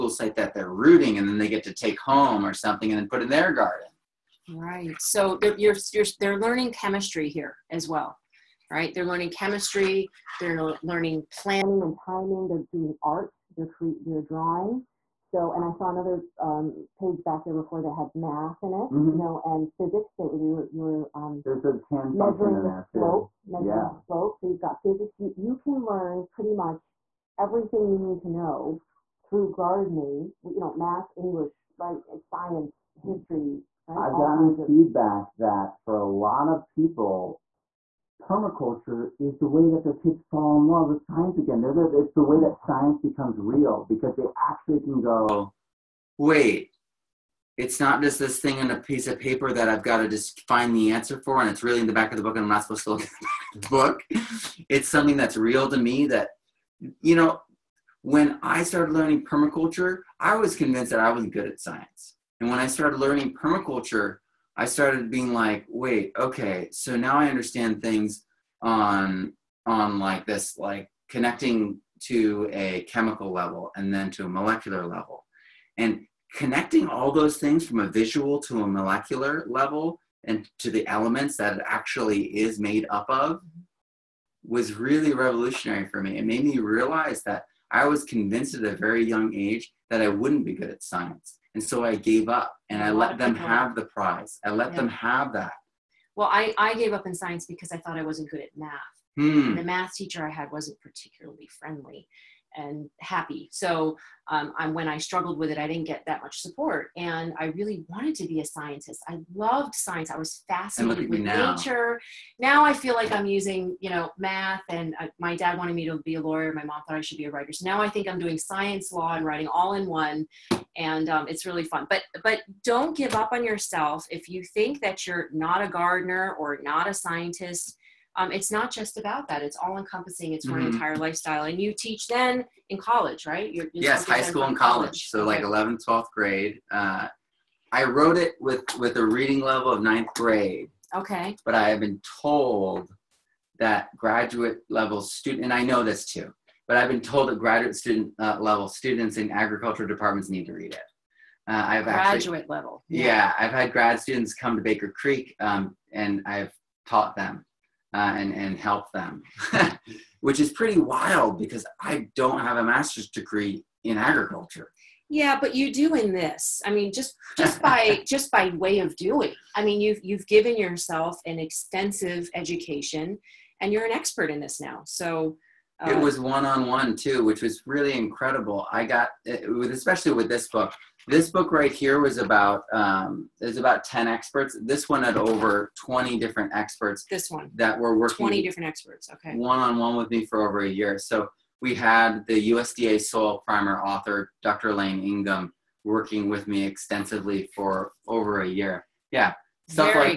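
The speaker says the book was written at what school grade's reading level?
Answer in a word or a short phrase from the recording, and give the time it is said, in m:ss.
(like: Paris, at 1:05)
Ninth grade, at 2:19.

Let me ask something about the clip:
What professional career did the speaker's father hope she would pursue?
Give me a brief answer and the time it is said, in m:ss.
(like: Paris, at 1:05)
Lawyer, at 1:56.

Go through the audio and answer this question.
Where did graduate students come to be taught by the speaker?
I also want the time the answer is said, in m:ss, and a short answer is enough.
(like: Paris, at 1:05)
Baker Creek, at 2:34.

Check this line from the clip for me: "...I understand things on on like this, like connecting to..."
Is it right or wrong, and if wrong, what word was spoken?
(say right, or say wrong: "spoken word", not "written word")
right.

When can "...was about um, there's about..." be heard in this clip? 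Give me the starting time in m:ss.
3:01.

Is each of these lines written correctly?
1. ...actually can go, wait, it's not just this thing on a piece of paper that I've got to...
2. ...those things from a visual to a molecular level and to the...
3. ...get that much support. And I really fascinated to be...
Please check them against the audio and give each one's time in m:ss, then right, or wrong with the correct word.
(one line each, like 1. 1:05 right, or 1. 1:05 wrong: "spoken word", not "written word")
1. 0:44 right
2. 1:17 right
3. 1:45 wrong: "wanted", not "fascinated".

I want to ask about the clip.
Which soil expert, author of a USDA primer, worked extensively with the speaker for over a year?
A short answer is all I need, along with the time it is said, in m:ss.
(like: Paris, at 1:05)
Dr. Elaine Ingham, at 3:14.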